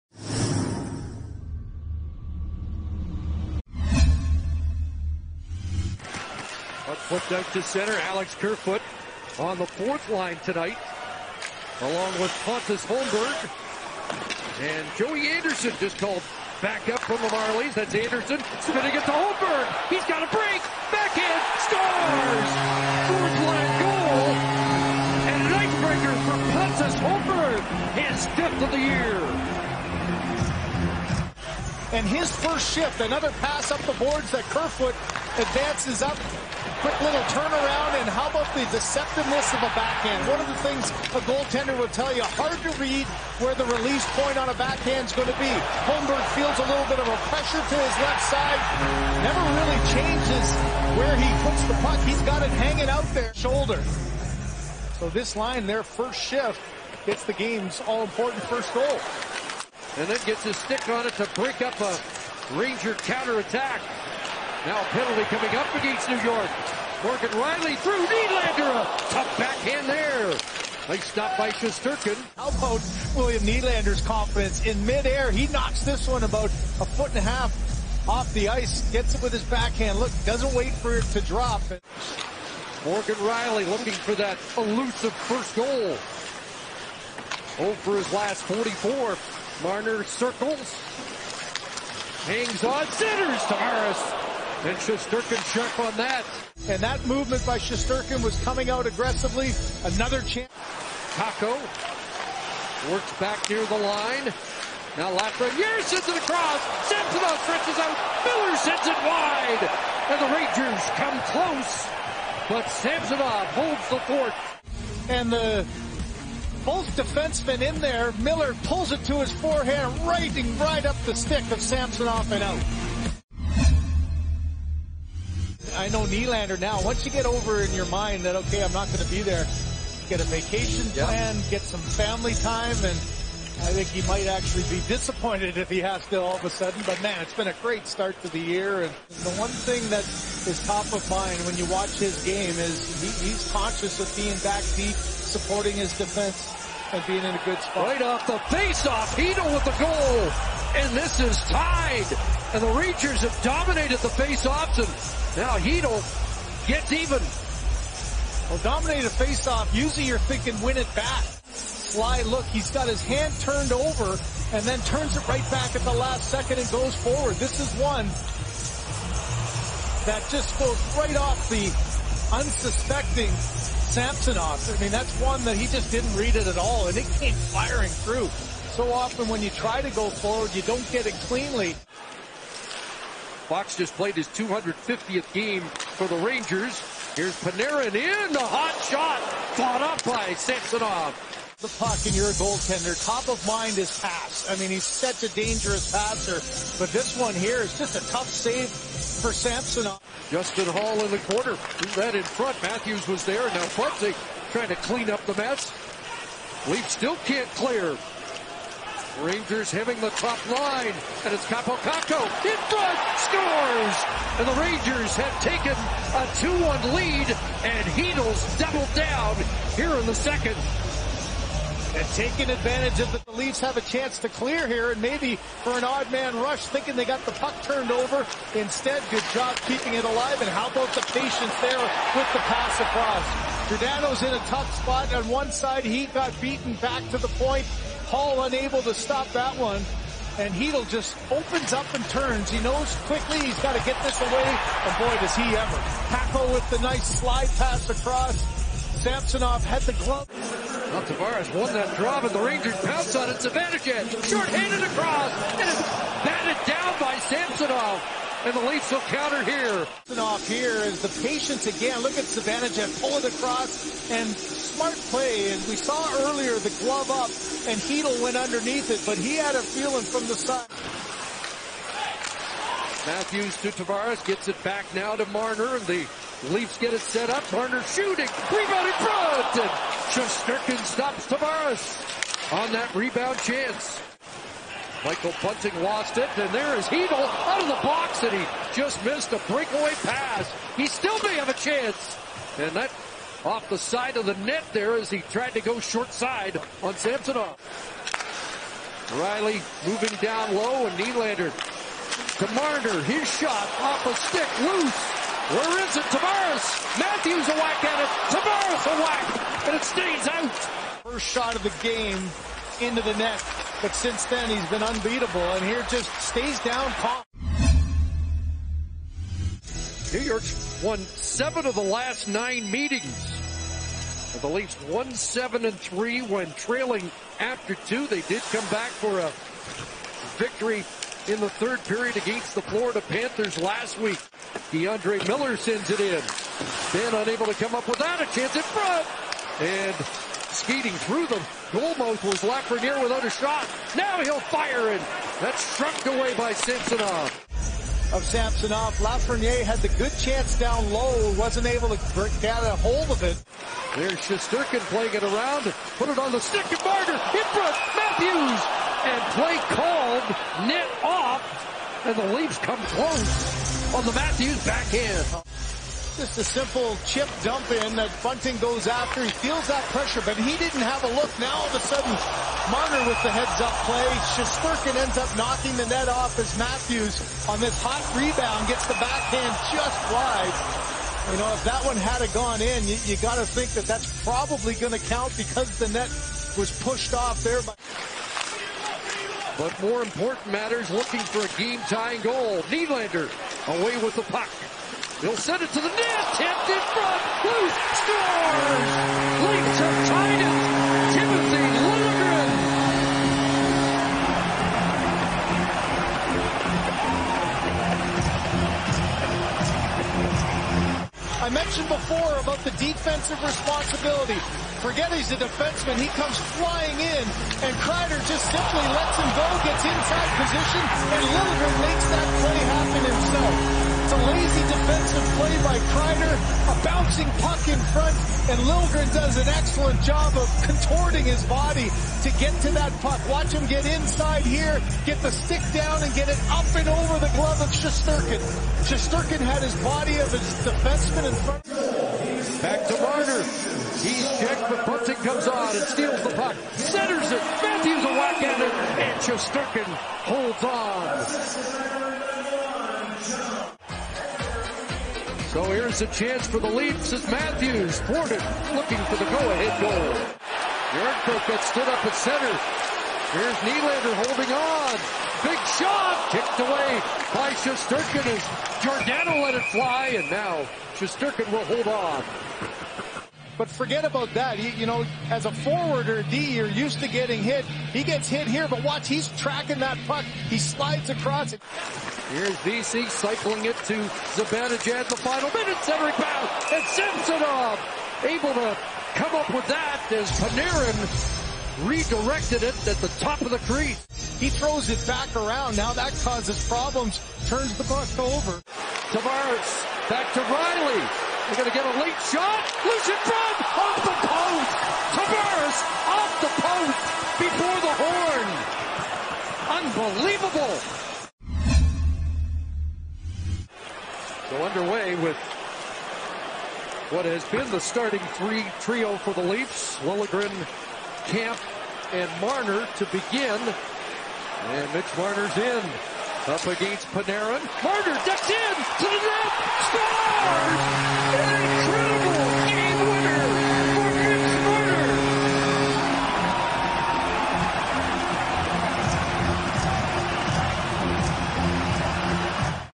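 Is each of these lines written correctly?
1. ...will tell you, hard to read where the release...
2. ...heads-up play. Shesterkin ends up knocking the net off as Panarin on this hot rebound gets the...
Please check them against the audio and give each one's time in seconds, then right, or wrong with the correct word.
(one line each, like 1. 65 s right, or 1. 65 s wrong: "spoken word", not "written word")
1. 41 s right
2. 373 s wrong: "Matthews", not "Panarin".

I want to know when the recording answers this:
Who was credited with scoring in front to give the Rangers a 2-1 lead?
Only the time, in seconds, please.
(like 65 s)
211 s.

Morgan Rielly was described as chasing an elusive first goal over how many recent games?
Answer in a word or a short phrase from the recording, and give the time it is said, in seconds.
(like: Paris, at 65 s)
44, at 88 s.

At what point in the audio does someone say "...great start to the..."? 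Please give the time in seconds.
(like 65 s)
137 s.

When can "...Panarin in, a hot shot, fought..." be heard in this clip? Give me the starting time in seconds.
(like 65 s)
187 s.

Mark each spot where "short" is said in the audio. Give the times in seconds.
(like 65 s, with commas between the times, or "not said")
253 s, 295 s.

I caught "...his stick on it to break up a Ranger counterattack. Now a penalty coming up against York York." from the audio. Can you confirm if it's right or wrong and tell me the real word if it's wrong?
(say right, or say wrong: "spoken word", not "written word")
wrong: "New", not "York".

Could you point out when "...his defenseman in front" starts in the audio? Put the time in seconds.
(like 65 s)
440 s.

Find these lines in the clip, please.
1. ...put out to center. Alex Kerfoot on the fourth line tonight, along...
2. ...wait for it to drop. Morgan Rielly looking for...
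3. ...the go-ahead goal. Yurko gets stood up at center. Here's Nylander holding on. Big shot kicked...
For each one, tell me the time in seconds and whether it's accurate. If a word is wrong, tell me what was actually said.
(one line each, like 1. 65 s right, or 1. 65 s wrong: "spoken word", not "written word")
1. 7 s right
2. 80 s right
3. 459 s right.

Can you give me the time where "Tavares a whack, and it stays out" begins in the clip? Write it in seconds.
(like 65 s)
308 s.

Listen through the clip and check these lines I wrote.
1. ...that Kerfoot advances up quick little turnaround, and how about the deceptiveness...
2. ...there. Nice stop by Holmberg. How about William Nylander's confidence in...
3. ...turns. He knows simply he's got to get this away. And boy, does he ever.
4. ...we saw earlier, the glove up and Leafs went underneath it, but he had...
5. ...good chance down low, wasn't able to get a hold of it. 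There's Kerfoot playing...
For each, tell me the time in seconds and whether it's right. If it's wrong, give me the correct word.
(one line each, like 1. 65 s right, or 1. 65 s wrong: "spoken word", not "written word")
1. 34 s right
2. 69 s wrong: "Shesterkin", not "Holmberg"
3. 242 s wrong: "quickly", not "simply"
4. 265 s wrong: "Chytil", not "Leafs"
5. 349 s wrong: "Shesterkin", not "Kerfoot".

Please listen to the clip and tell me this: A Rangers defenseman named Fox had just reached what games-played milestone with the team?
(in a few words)
250.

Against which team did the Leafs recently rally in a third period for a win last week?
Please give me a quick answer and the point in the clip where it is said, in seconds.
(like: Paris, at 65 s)
Florida Panthers, at 332 s.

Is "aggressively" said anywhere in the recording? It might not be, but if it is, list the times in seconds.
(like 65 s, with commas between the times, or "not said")
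98 s.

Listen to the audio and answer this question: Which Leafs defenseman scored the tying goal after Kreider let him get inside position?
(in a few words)
Timothy Liljegren.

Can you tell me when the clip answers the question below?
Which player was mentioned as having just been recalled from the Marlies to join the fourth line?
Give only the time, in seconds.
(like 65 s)
14 s.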